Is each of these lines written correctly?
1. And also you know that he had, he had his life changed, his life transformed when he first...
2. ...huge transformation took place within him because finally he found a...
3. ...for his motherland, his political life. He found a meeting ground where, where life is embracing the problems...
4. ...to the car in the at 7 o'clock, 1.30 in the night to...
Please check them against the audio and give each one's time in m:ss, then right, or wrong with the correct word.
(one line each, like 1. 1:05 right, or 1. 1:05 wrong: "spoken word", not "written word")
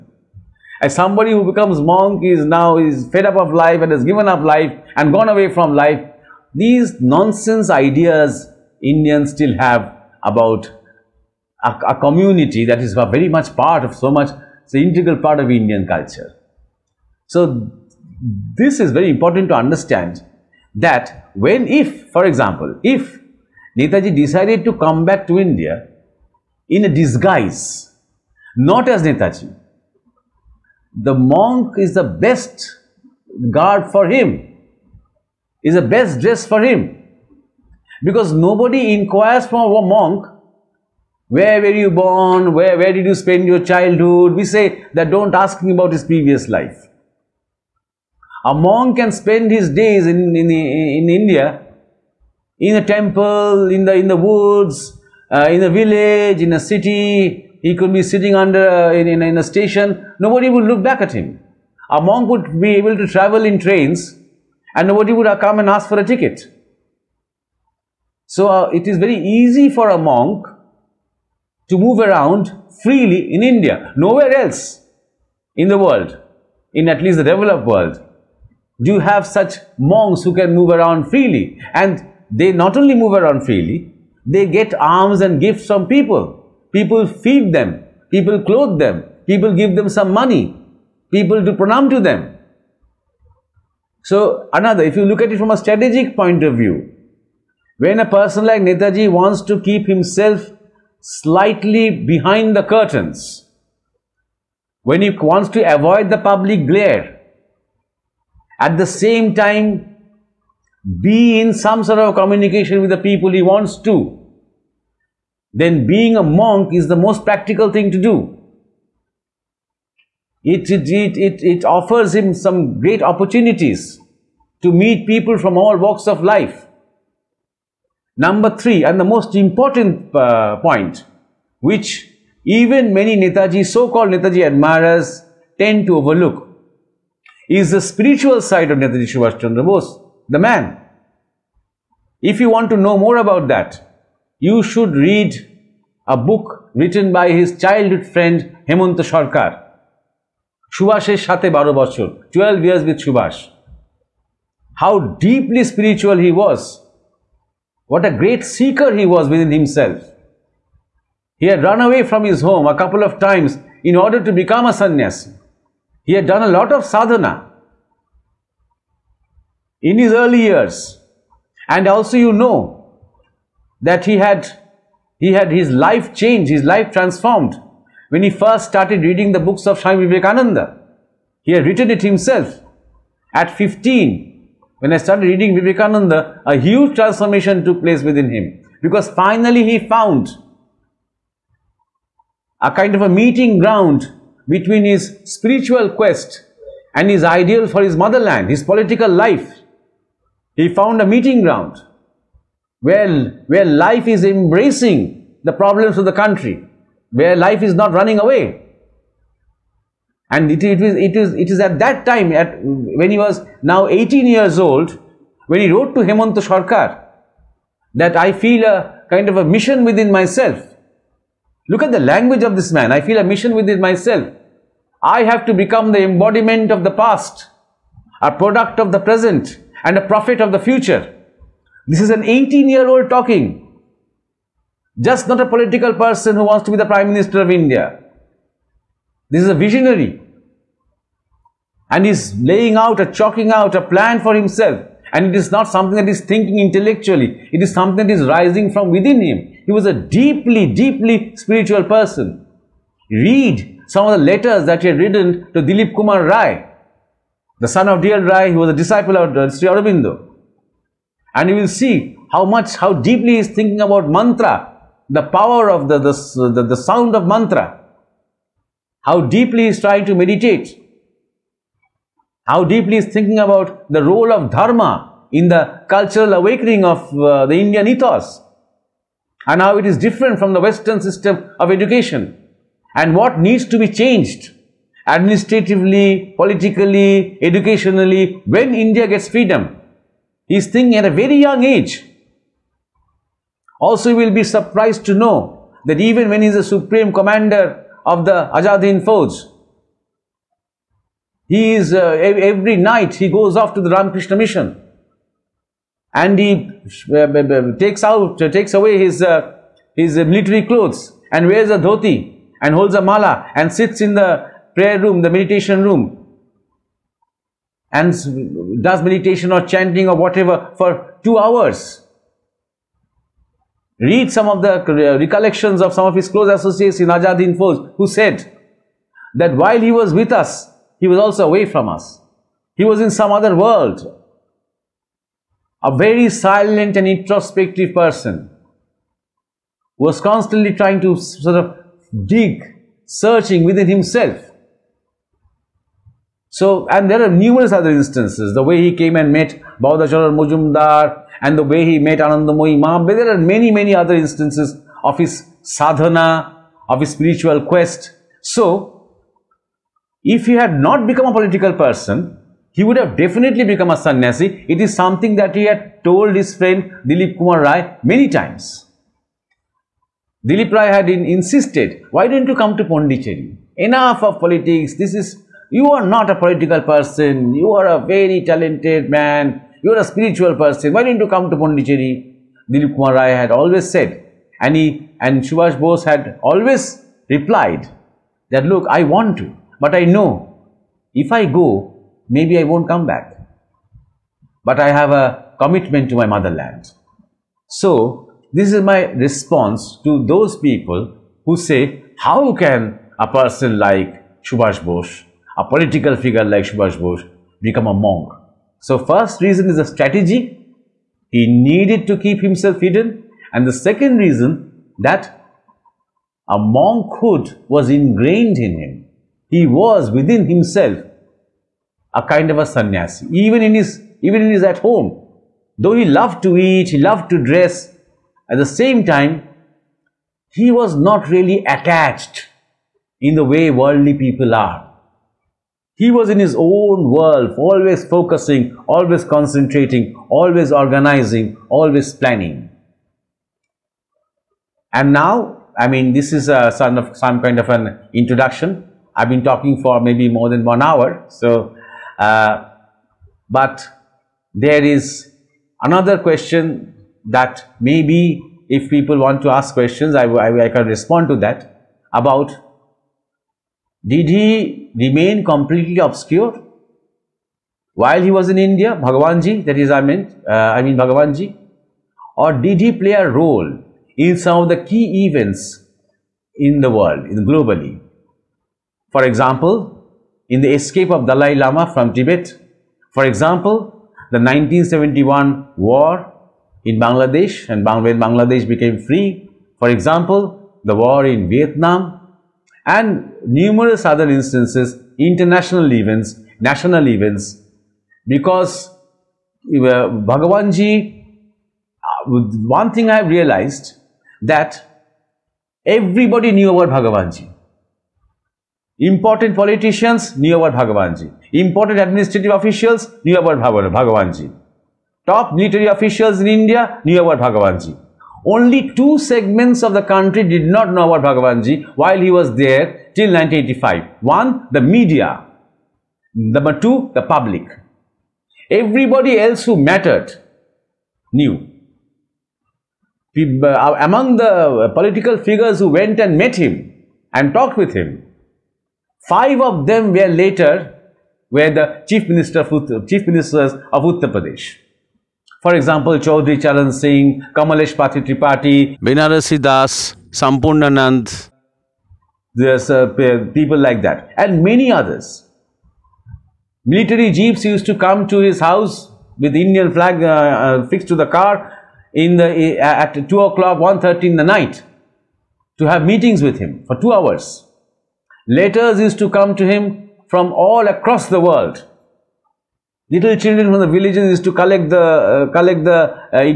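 1. 2:51 right
2. 3:06 right
3. 3:17 right
4. 9:21 wrong: "2", not "7".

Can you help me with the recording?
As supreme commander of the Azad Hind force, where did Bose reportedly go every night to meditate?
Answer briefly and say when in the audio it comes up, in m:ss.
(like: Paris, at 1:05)
Ramakrishna Mission, at 5:03.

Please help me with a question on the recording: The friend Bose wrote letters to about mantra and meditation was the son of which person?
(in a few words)
D.L. Roy.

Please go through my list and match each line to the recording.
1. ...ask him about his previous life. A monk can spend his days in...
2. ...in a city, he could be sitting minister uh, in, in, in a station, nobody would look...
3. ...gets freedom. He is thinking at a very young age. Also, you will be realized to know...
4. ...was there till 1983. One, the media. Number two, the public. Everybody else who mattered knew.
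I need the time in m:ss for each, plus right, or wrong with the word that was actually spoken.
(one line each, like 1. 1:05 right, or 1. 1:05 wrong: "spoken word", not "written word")
1. 0:45 right
2. 0:56 wrong: "under", not "minister"
3. 4:49 wrong: "surprised", not "realized"
4. 8:42 wrong: "1985", not "1983".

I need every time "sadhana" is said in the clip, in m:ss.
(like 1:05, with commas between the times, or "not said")
2:46, 5:55.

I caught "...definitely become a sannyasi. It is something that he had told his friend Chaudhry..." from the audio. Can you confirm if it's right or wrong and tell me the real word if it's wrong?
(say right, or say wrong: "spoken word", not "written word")
wrong: "Dilip", not "Chaudhry".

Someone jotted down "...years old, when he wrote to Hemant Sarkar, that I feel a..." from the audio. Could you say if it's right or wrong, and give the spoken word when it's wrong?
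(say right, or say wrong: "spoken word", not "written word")
right.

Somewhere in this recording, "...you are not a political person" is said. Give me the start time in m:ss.
6:15.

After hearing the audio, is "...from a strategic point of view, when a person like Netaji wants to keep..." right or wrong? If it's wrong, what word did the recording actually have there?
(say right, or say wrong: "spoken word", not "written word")
right.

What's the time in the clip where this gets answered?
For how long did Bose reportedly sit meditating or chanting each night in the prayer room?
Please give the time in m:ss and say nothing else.
5:21.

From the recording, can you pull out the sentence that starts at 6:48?
So first reason is a strategy.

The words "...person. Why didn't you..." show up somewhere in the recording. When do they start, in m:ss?
6:20.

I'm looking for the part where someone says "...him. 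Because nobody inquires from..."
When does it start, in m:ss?
0:36.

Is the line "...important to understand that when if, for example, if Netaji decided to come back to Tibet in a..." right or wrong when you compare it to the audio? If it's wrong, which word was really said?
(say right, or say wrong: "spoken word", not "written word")
wrong: "India", not "Tibet".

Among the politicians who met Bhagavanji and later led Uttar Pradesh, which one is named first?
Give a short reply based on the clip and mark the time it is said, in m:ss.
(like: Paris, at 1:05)
Chaudhry Charan Singh, at 9:06.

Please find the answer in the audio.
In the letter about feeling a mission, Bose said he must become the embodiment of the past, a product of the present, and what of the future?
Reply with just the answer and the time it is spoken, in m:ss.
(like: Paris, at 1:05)
a prophet, at 3:49.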